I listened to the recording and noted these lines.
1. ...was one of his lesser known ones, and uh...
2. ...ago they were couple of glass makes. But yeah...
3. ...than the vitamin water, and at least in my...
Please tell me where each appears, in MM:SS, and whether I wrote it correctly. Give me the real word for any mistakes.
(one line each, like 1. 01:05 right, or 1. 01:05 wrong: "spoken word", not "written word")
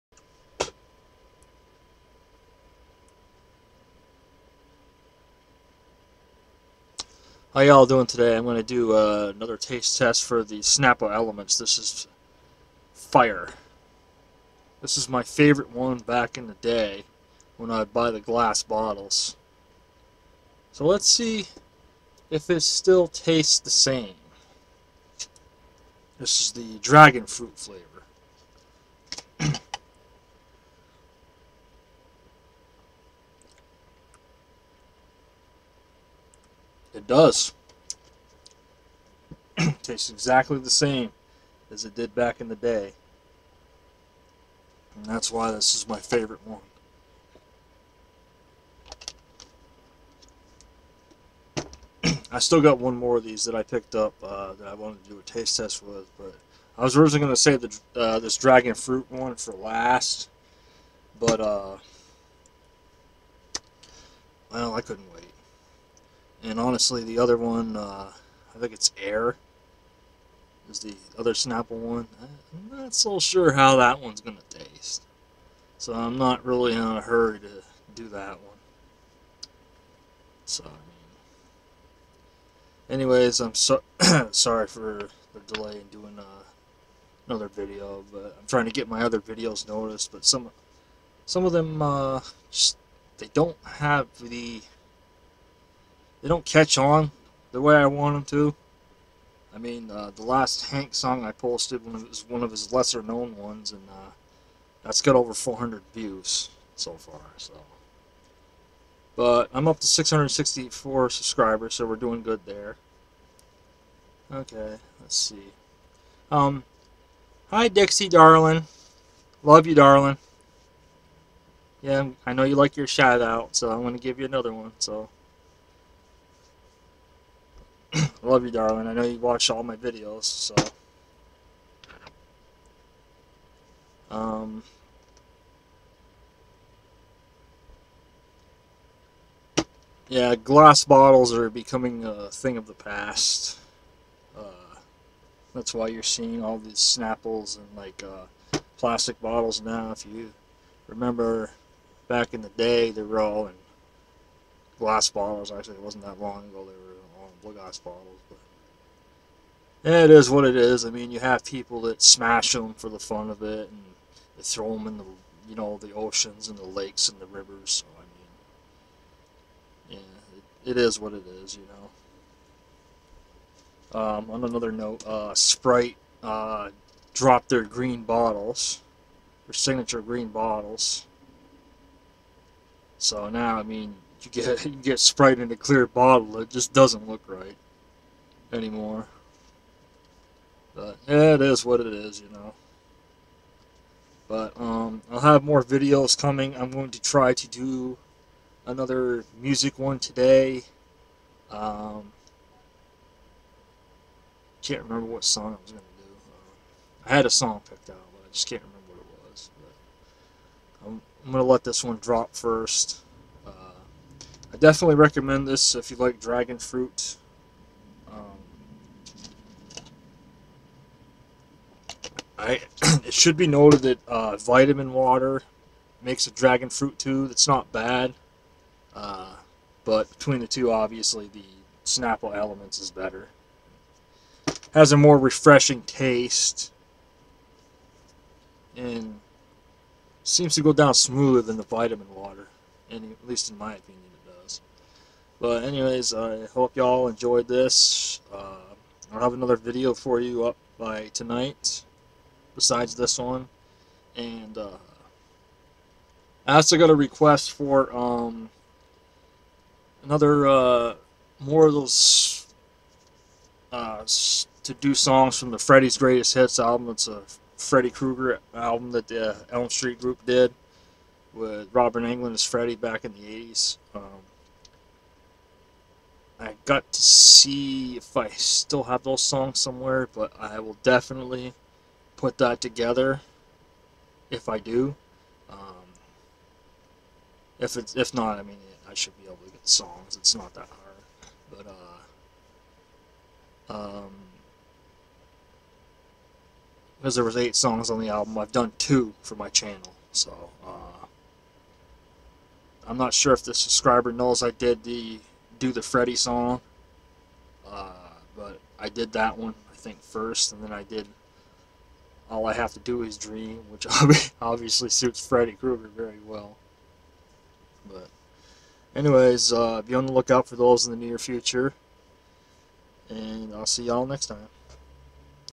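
1. 01:41 right
2. 02:36 wrong: "bottles", not "makes"
3. 04:01 right.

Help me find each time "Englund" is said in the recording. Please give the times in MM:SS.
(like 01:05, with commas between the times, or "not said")
04:32.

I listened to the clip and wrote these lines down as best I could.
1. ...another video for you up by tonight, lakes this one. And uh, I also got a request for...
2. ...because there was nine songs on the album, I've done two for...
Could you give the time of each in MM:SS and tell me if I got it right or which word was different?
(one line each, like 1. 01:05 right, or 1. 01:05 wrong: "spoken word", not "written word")
1. 04:09 wrong: "besides", not "lakes"
2. 04:56 wrong: "eight", not "nine".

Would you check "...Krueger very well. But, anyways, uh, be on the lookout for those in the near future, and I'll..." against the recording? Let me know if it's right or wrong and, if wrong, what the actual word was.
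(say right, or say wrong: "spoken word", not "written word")
right.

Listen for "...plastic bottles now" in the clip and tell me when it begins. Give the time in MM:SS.
02:28.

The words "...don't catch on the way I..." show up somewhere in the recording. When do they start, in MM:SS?
01:36.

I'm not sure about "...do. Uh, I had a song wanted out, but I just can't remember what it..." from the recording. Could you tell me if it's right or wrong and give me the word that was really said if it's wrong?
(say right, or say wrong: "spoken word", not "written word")
wrong: "picked", not "wanted".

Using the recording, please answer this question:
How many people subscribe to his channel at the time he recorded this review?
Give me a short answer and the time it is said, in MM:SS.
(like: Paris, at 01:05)
664, at 01:49.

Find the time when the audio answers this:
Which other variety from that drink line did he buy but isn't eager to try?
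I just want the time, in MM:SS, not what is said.
01:09.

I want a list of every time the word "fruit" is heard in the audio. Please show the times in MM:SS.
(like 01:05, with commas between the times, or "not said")
00:27, 00:58, 03:36, 03:46.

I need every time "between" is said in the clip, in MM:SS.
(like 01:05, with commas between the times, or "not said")
03:50.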